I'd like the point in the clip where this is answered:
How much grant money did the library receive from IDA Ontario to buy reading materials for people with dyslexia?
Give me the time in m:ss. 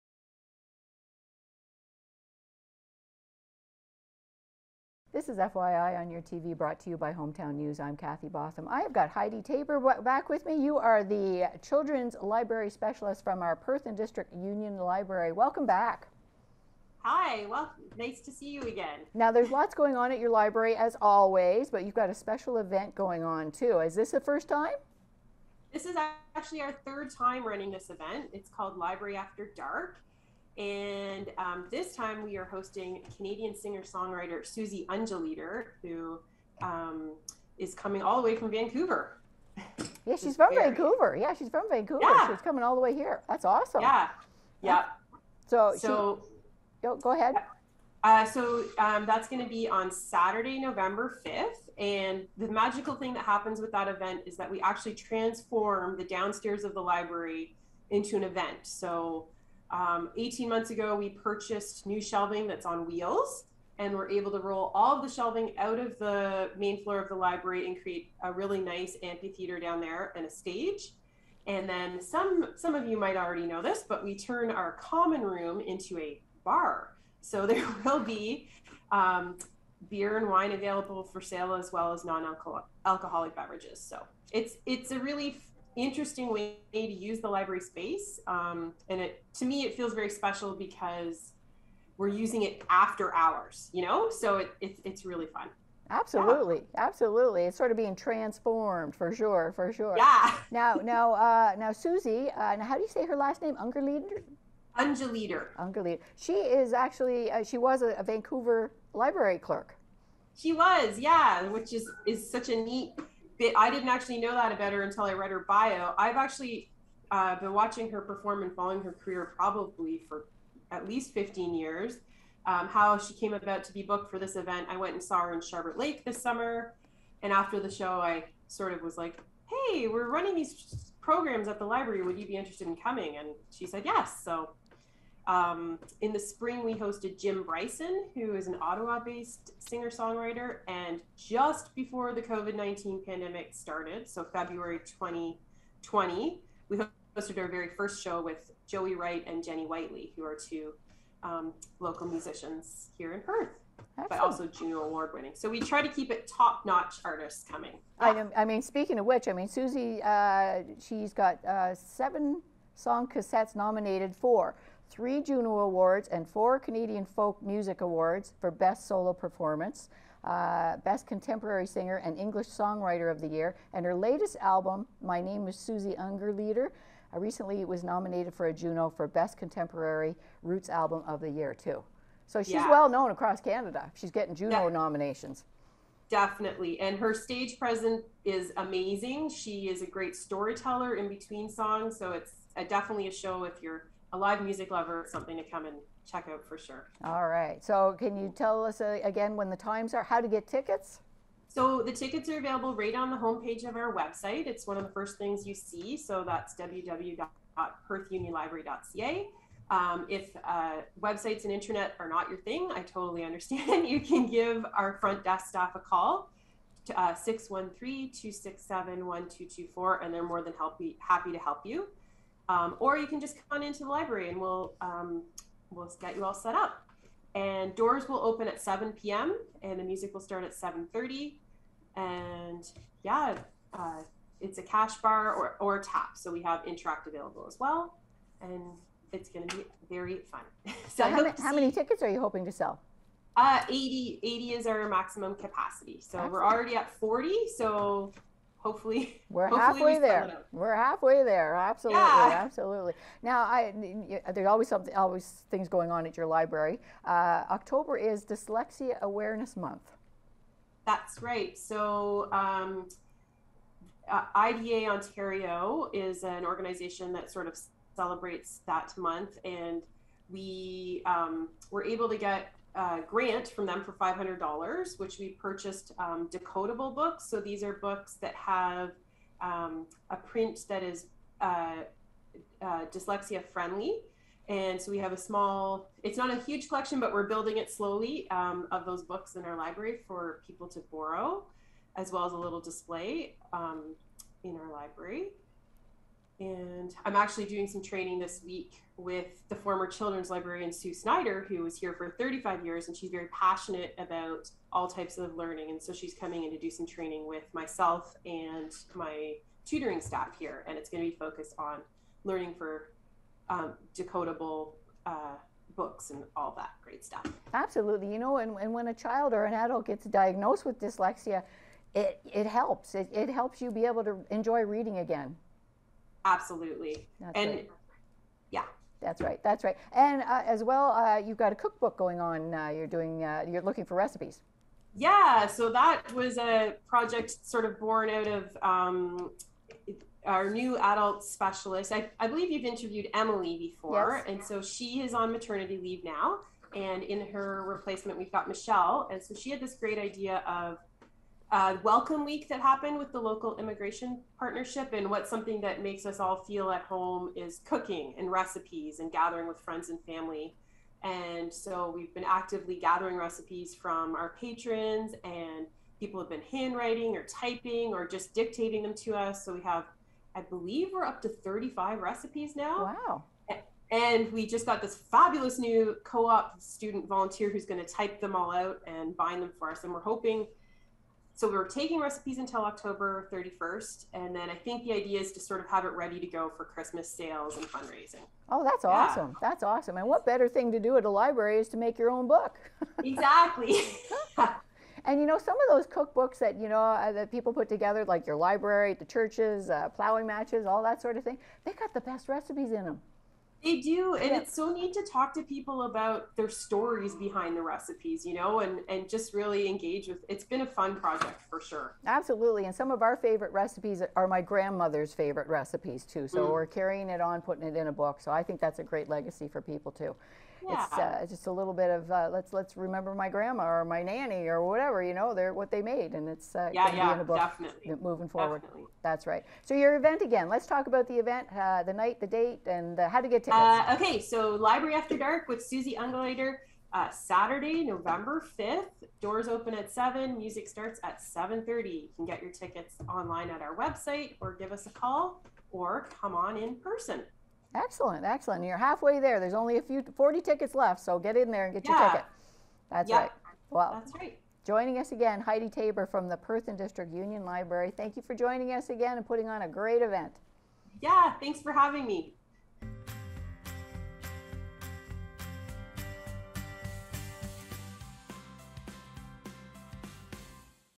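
4:33.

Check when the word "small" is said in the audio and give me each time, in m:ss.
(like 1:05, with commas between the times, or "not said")
4:45.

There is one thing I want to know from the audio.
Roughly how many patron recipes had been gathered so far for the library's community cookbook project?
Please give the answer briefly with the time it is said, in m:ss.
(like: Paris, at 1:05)
35, at 6:11.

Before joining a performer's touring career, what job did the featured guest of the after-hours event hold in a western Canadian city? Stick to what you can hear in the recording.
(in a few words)
Library clerk.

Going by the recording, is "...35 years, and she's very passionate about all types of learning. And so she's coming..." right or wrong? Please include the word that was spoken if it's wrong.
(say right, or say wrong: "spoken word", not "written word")
right.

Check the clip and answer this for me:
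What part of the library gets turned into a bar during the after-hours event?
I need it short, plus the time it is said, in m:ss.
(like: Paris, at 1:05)
Common room, at 1:14.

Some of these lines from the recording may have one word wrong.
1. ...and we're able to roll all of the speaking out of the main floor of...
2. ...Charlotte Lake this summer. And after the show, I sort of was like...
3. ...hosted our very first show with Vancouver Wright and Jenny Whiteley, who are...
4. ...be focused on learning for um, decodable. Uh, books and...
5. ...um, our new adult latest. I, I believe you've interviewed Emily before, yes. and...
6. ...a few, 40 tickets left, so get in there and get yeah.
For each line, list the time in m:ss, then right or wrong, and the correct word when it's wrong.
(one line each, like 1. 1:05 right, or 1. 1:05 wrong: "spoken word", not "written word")
1. 1:03 wrong: "shelving", not "speaking"
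2. 2:05 right
3. 2:26 wrong: "Joey", not "Vancouver"
4. 5:11 right
5. 5:38 wrong: "specialist", not "latest"
6. 7:29 right.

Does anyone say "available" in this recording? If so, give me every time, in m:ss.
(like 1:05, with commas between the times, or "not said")
1:20, 3:22, 3:57.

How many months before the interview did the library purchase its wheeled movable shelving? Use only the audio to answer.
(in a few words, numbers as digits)
18 months.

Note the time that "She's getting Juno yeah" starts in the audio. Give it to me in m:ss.
3:03.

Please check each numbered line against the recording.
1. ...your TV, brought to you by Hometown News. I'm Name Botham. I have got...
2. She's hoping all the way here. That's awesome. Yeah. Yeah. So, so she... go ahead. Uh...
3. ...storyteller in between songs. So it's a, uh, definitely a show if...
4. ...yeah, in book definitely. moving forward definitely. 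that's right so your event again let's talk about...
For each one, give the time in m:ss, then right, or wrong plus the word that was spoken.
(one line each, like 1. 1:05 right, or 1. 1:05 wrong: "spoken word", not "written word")
1. 0:06 wrong: "Kathy", not "Name"
2. 0:42 wrong: "coming", not "hoping"
3. 3:10 right
4. 7:06 right.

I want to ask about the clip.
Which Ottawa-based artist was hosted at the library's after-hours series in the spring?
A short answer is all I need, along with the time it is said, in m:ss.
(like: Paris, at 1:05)
Jim Bryson, at 2:17.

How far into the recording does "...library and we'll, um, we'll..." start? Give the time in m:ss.
3:43.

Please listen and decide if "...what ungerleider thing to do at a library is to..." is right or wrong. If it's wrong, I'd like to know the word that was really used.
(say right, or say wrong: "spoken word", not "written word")
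wrong: "better", not "ungerleider".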